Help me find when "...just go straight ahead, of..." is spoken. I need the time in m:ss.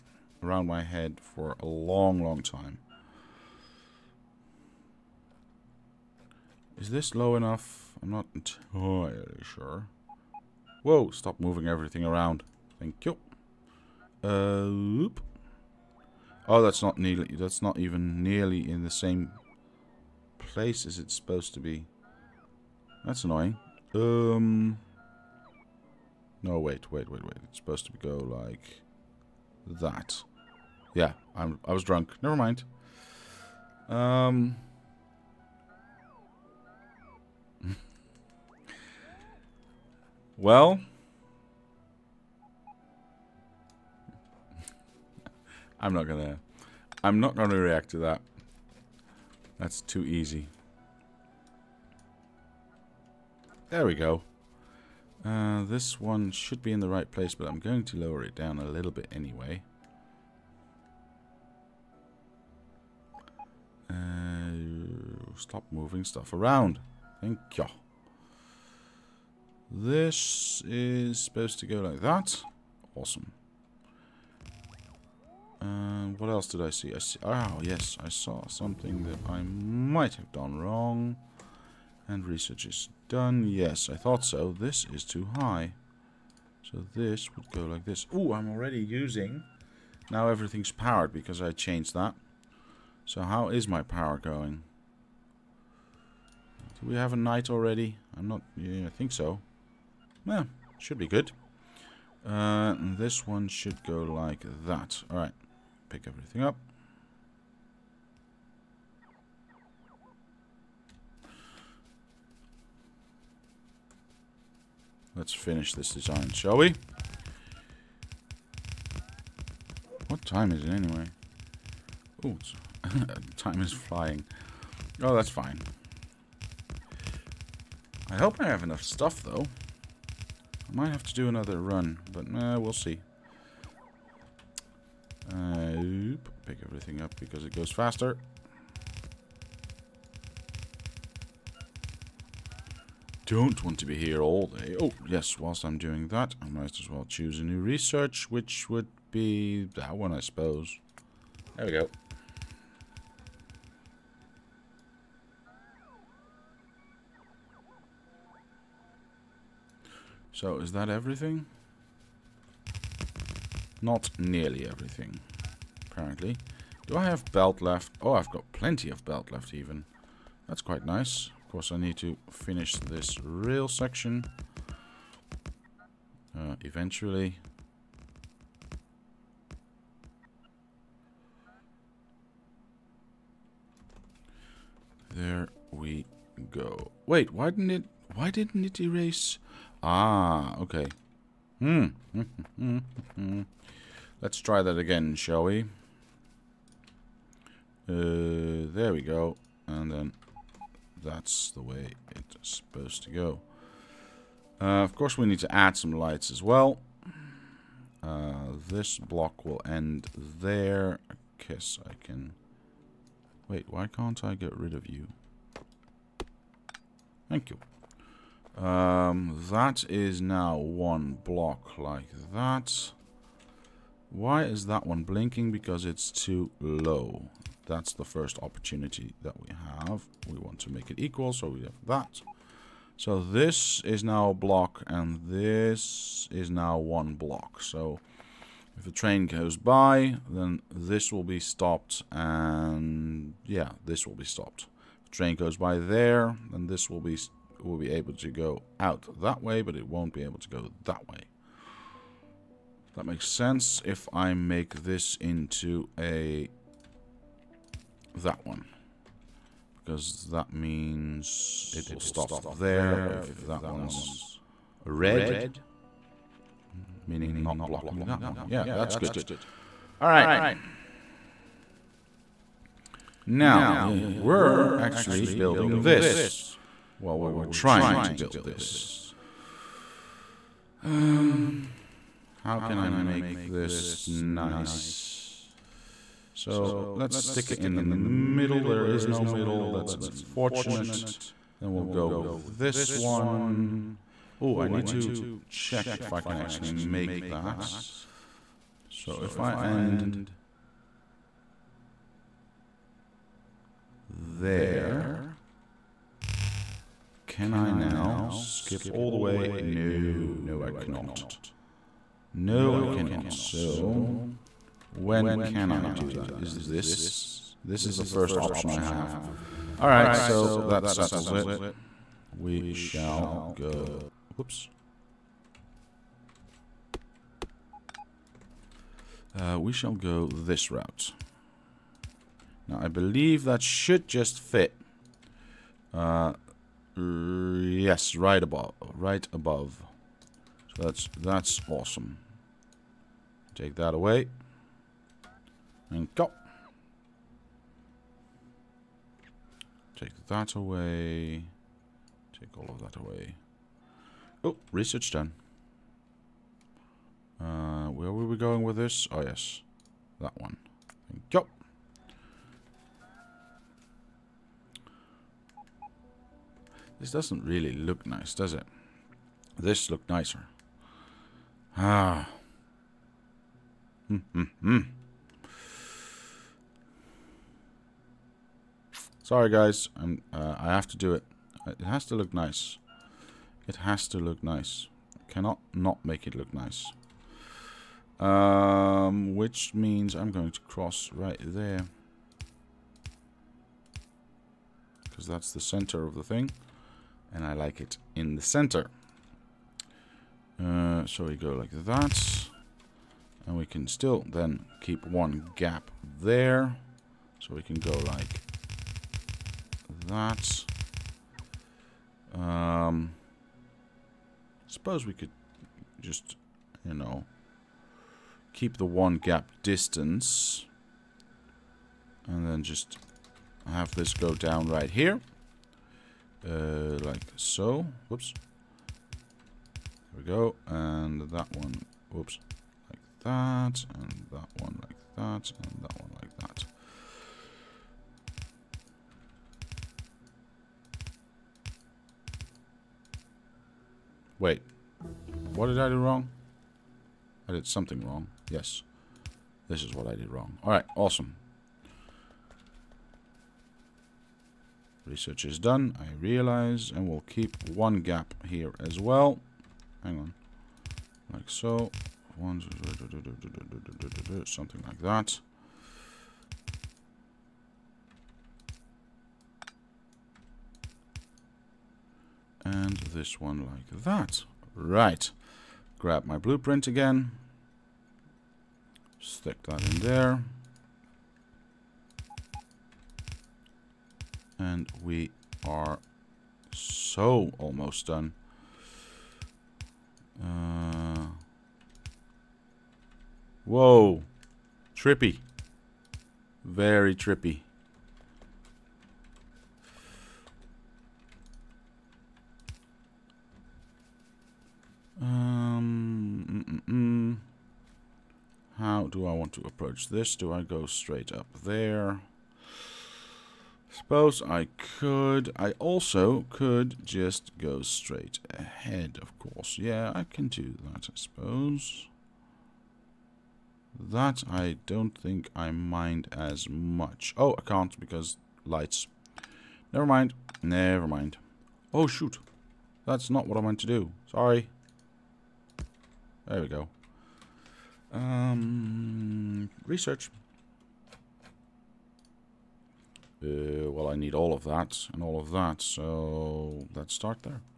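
8:37.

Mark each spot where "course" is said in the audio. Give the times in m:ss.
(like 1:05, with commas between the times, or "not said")
2:51, 3:24, 8:39.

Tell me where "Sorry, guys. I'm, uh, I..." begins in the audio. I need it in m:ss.
6:19.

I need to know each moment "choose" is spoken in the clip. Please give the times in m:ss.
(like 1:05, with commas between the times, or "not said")
2:27.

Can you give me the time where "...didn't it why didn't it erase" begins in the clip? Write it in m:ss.
3:07.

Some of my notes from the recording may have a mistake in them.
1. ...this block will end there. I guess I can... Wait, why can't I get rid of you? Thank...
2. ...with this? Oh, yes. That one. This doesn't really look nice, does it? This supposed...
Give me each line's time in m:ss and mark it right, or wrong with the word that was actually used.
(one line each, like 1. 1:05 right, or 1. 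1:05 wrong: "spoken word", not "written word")
1. 3:28 right
2. 5:58 wrong: "looked", not "supposed".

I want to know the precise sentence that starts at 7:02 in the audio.
And then just have this go down right here.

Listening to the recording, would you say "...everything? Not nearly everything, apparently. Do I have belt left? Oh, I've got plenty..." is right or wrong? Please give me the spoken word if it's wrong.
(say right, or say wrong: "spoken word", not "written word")
right.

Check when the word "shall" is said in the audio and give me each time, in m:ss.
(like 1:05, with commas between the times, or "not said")
1:56, 3:15, 5:22, 5:29.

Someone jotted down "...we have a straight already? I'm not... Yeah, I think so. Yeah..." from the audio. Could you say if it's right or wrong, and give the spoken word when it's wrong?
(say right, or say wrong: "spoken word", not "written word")
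wrong: "night", not "straight".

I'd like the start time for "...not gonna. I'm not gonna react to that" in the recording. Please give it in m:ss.
0:45.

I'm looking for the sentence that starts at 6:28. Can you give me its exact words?
Um, which means I'm going to cross right there.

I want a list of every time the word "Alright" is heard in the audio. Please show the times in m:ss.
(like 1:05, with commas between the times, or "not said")
1:45, 4:30, 5:19.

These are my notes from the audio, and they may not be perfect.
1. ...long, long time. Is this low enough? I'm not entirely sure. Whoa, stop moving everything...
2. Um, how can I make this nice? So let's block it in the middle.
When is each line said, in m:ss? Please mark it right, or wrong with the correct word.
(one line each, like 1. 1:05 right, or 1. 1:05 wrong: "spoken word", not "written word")
1. 0:01 right
2. 4:40 wrong: "stick", not "block".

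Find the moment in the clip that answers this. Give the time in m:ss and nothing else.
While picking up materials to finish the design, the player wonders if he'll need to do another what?
2:10.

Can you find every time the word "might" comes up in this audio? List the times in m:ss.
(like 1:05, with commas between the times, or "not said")
1:19, 2:10, 2:26.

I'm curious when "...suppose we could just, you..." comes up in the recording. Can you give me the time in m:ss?
6:54.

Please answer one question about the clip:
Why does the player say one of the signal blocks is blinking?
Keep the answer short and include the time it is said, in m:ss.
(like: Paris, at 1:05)
too low, at 3:45.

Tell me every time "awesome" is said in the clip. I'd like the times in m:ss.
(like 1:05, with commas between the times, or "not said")
1:12, 5:41, 7:30.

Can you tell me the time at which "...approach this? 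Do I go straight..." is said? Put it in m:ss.
8:29.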